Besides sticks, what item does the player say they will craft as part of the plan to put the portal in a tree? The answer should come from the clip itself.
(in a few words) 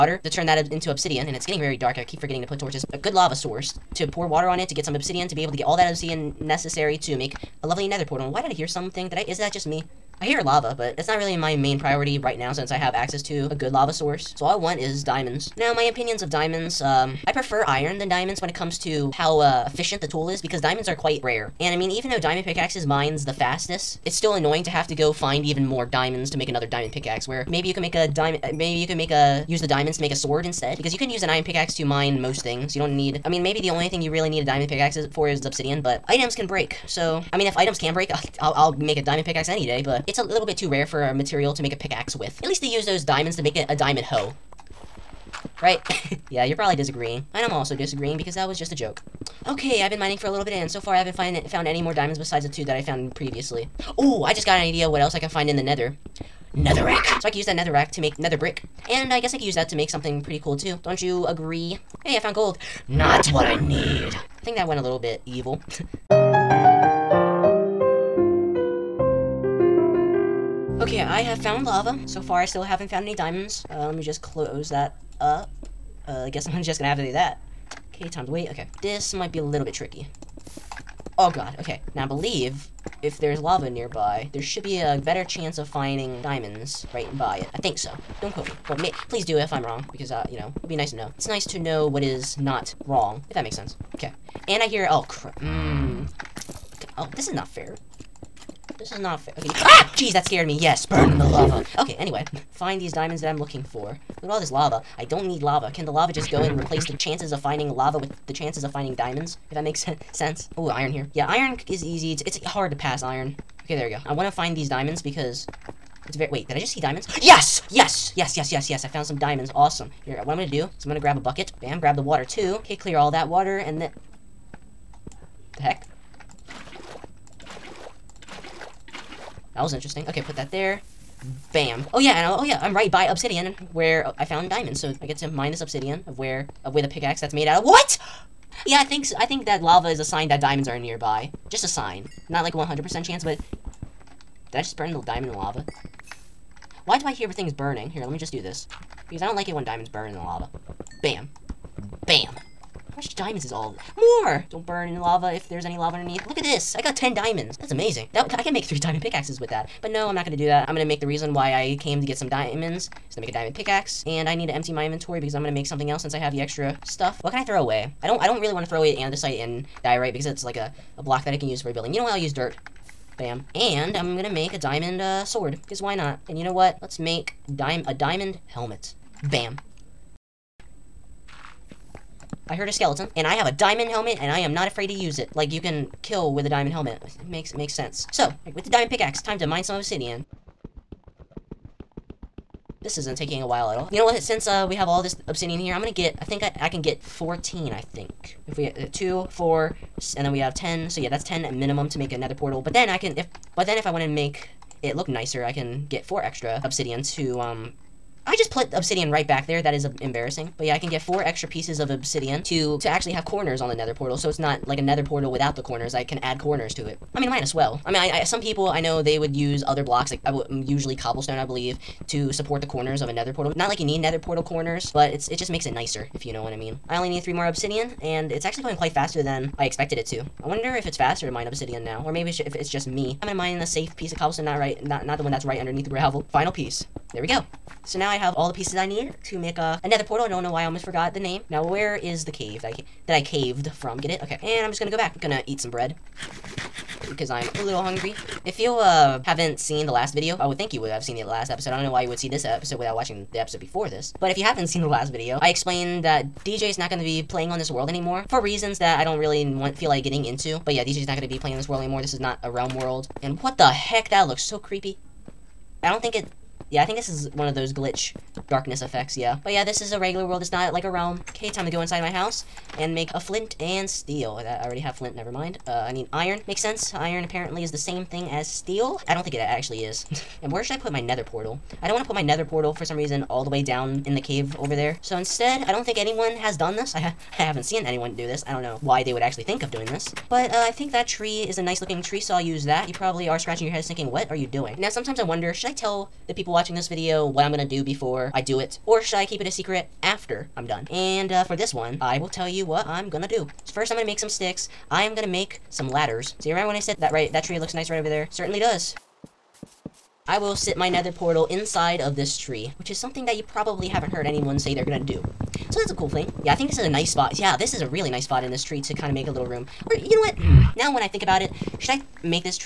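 ladders.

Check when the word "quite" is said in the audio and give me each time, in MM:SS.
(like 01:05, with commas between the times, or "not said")
00:20, 03:48.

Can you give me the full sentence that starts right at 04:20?
But yeah, DJ is not going to be playing this world anymore.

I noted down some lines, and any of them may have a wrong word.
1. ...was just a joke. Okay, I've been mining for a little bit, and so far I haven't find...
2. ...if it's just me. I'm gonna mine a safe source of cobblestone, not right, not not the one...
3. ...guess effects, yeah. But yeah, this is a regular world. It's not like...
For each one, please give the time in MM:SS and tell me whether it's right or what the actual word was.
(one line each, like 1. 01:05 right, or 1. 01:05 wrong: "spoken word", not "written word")
1. 00:48 right
2. 03:52 wrong: "piece", not "source"
3. 04:28 wrong: "darkness", not "guess".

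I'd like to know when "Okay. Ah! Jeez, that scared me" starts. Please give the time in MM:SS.
01:39.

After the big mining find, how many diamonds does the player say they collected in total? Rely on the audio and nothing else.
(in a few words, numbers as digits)
10.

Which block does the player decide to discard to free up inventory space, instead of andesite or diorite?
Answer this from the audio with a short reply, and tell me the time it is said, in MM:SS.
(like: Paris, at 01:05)
dirt, at 02:52.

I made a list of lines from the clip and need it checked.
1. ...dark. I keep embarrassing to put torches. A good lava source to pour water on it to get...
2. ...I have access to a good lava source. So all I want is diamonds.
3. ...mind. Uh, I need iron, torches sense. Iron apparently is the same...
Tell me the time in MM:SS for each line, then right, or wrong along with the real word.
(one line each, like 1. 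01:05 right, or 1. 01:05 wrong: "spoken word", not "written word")
1. 00:01 wrong: "forgetting", not "embarrassing"
2. 00:12 right
3. 04:35 wrong: "makes", not "torches".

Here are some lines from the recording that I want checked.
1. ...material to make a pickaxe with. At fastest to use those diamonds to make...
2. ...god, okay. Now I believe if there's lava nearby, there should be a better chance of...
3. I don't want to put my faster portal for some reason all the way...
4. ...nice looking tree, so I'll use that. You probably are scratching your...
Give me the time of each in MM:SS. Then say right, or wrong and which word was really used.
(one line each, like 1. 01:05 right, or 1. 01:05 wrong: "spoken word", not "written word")
1. 00:41 wrong: "least", not "fastest"
2. 01:21 right
3. 04:41 wrong: "nether", not "faster"
4. 04:51 right.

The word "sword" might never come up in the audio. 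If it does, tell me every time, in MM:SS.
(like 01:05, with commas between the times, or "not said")
00:30, 02:55.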